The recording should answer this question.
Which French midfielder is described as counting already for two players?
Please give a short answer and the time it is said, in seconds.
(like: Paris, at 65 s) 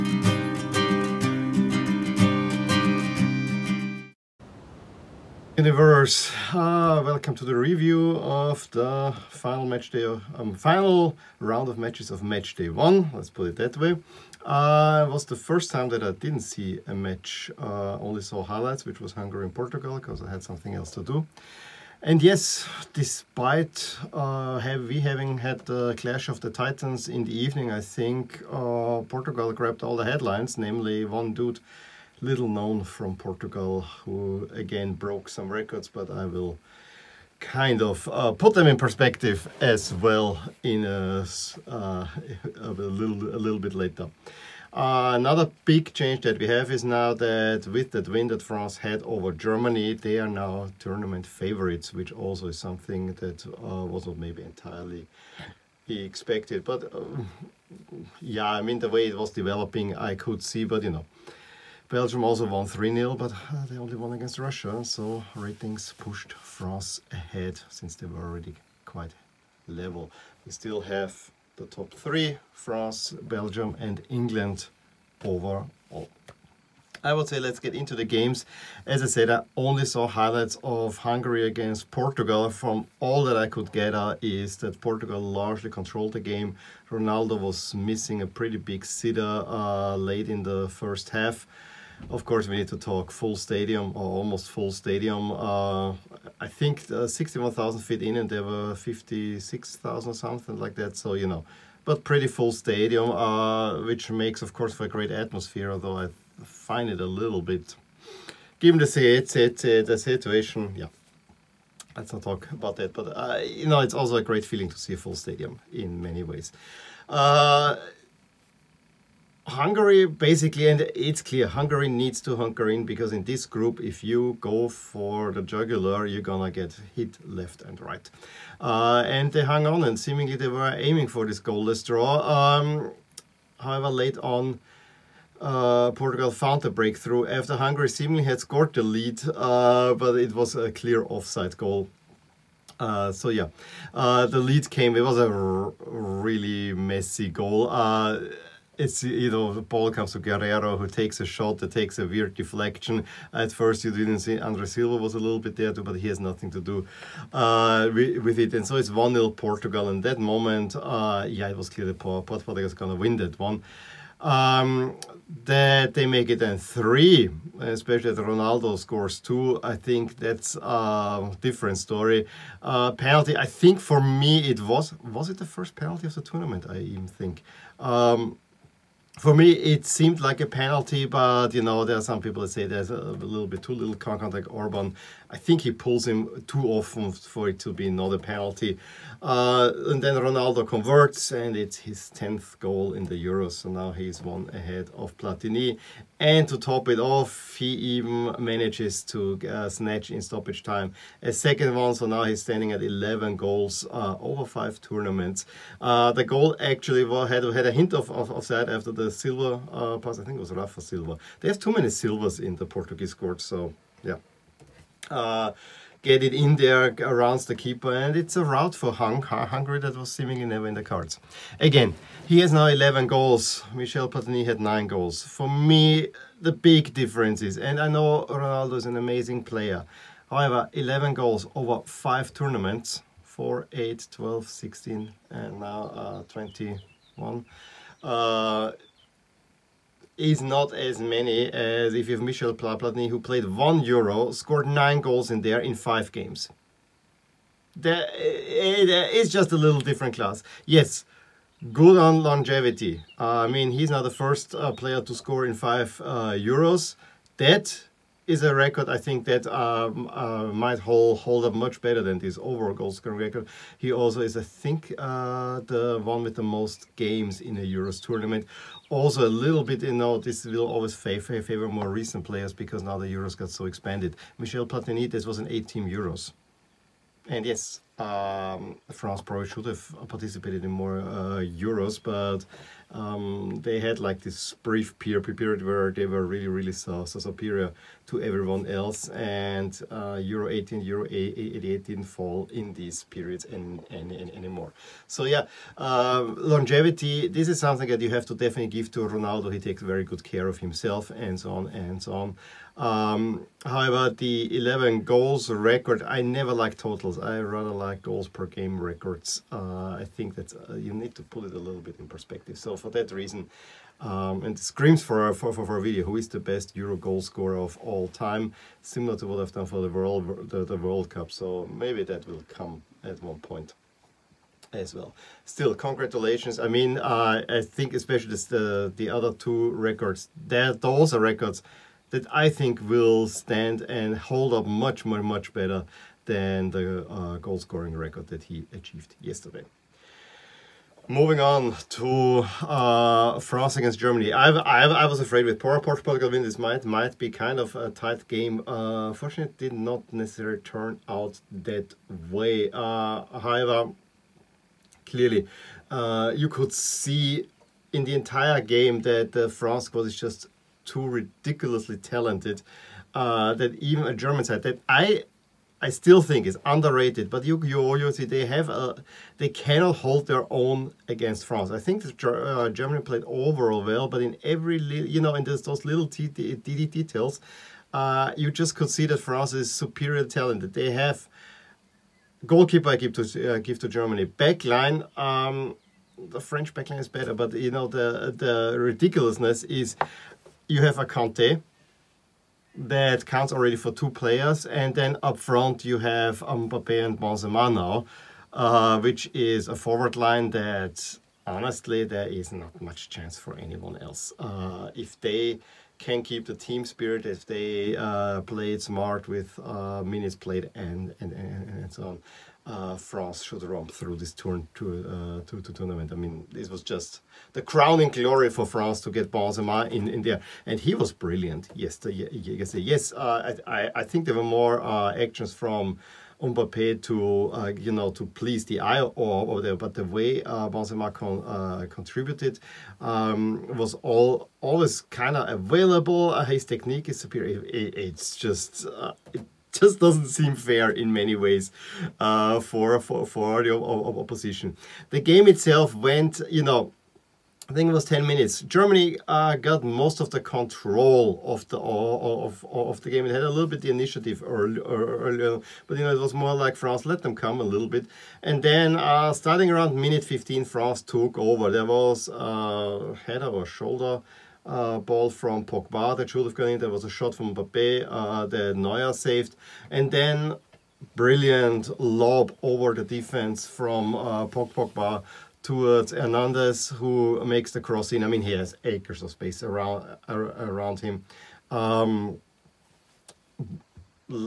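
Kanté, at 391 s.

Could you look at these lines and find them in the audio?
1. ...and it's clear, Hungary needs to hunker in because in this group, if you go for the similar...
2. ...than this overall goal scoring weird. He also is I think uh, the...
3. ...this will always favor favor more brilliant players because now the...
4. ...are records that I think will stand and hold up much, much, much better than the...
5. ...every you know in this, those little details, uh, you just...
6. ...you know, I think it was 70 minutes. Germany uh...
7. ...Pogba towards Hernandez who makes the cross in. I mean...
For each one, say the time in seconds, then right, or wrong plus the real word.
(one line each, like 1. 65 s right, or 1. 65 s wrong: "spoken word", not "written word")
1. 120 s wrong: "jugular", not "similar"
2. 262 s wrong: "record", not "weird"
3. 270 s wrong: "recent", not "brilliant"
4. 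331 s right
5. 374 s right
6. 446 s wrong: "10", not "70"
7. 474 s right.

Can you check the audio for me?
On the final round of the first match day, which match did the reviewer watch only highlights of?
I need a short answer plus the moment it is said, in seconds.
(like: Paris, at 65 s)
Hungary and Portugal, at 19 s.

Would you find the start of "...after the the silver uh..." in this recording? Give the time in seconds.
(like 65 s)
208 s.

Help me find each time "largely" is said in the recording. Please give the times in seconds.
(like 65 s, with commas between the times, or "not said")
85 s.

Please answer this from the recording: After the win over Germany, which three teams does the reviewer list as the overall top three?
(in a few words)
France, Belgium and England.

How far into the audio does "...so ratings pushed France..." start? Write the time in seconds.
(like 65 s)
64 s.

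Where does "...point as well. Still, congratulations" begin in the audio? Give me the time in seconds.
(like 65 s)
323 s.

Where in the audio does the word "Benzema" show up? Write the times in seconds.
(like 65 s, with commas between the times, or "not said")
397 s, 419 s, 430 s.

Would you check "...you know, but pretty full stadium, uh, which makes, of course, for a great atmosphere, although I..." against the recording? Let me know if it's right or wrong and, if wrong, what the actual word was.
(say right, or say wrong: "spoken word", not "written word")
right.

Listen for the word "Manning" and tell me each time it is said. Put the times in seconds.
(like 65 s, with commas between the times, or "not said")
not said.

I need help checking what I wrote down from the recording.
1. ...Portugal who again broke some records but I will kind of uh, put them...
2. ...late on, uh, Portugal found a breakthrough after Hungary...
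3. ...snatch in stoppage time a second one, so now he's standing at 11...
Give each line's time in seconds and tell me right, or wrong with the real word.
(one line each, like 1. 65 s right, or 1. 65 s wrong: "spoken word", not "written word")
1. 33 s right
2. 133 s right
3. 199 s right.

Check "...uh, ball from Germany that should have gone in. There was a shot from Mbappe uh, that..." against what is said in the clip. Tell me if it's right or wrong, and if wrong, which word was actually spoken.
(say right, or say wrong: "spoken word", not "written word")
wrong: "Pogba", not "Germany".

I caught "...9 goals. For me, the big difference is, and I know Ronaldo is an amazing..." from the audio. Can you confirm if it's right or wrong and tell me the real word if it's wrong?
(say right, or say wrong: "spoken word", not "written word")
right.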